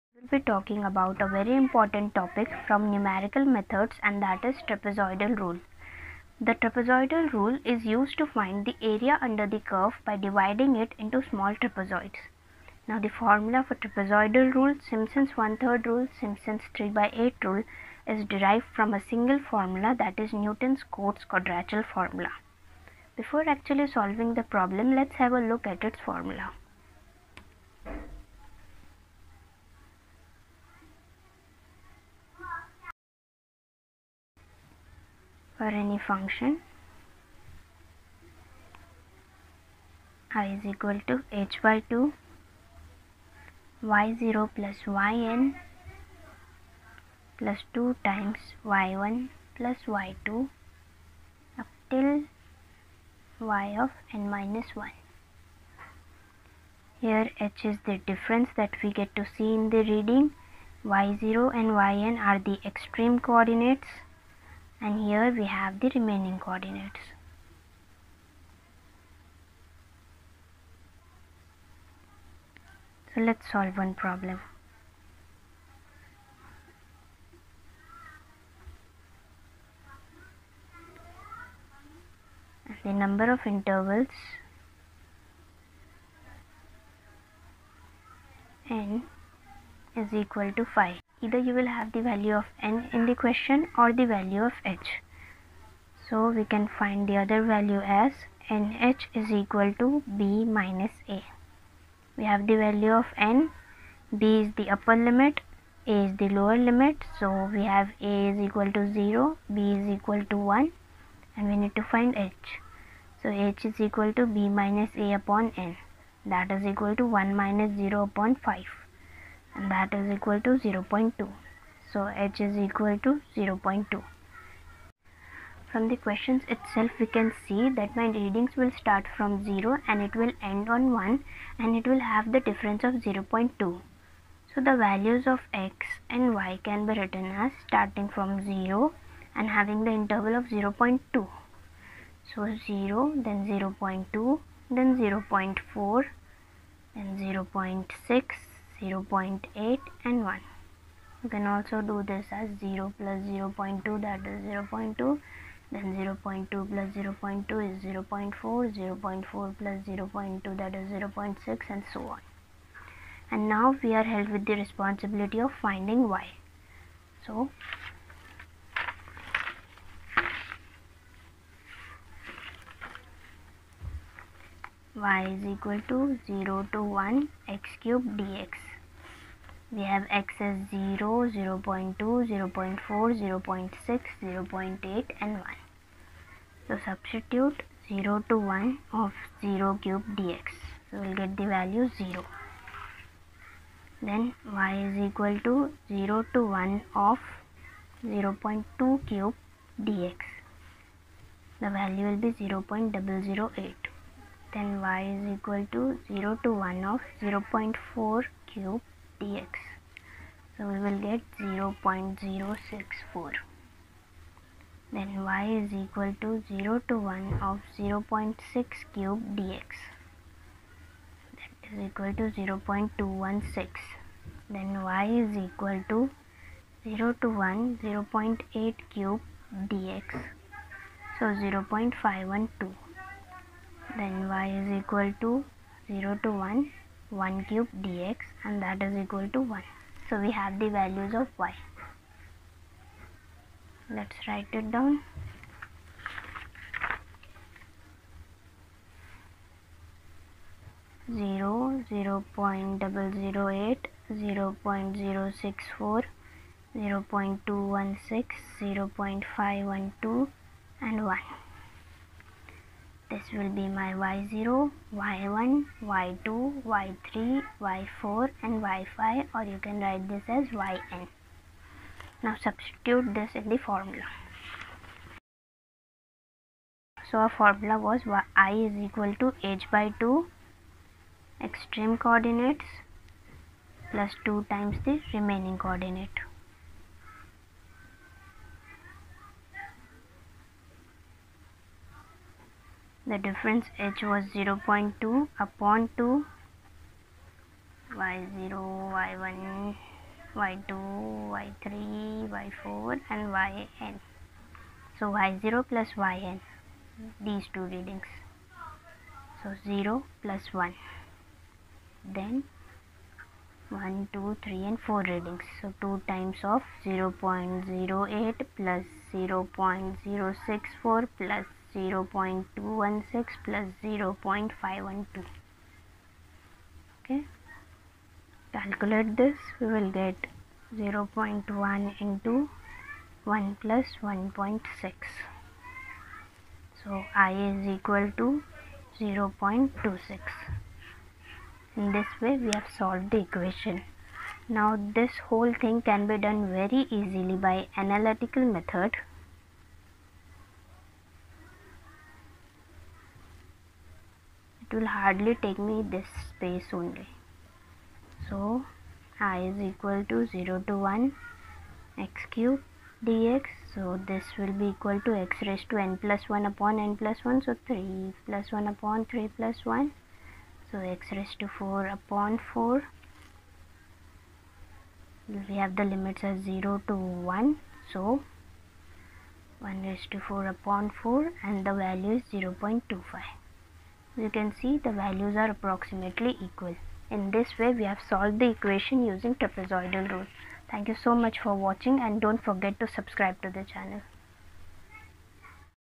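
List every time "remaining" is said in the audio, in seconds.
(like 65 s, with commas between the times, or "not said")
65 s, 285 s.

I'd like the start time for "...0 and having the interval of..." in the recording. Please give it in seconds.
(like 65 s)
138 s.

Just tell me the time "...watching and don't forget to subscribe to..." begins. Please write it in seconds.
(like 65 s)
391 s.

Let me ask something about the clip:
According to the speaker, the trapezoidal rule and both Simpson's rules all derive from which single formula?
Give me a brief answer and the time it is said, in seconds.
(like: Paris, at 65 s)
Newton's Cotes quadrature formula, at 20 s.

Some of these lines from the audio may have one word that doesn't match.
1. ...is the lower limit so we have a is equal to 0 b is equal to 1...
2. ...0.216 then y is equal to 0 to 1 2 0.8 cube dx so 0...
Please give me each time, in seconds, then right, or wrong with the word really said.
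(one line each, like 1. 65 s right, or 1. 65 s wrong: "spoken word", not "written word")
1. 106 s right
2. 222 s wrong: "0", not "2".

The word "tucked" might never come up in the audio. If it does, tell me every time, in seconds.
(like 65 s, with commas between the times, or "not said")
not said.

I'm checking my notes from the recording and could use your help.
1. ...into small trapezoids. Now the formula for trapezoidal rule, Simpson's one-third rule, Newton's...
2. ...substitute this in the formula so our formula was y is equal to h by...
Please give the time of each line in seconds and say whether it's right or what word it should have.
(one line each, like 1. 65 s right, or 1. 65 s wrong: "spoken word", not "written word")
1. 10 s wrong: "Simpson", not "Newton"
2. 272 s right.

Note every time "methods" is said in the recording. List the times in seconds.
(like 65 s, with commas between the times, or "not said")
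3 s, 348 s.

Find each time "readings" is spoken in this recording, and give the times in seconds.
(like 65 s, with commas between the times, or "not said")
59 s, 128 s, 307 s, 315 s.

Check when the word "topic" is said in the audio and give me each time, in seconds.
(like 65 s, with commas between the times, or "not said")
2 s.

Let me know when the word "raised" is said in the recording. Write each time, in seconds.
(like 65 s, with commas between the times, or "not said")
365 s, 371 s, 379 s.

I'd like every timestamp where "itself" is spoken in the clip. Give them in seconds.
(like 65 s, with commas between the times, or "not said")
126 s.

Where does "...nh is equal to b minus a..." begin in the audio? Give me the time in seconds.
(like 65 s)
98 s.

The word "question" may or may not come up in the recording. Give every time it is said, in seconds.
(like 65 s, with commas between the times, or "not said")
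93 s, 126 s.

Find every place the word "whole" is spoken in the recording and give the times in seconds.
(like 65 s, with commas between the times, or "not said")
345 s.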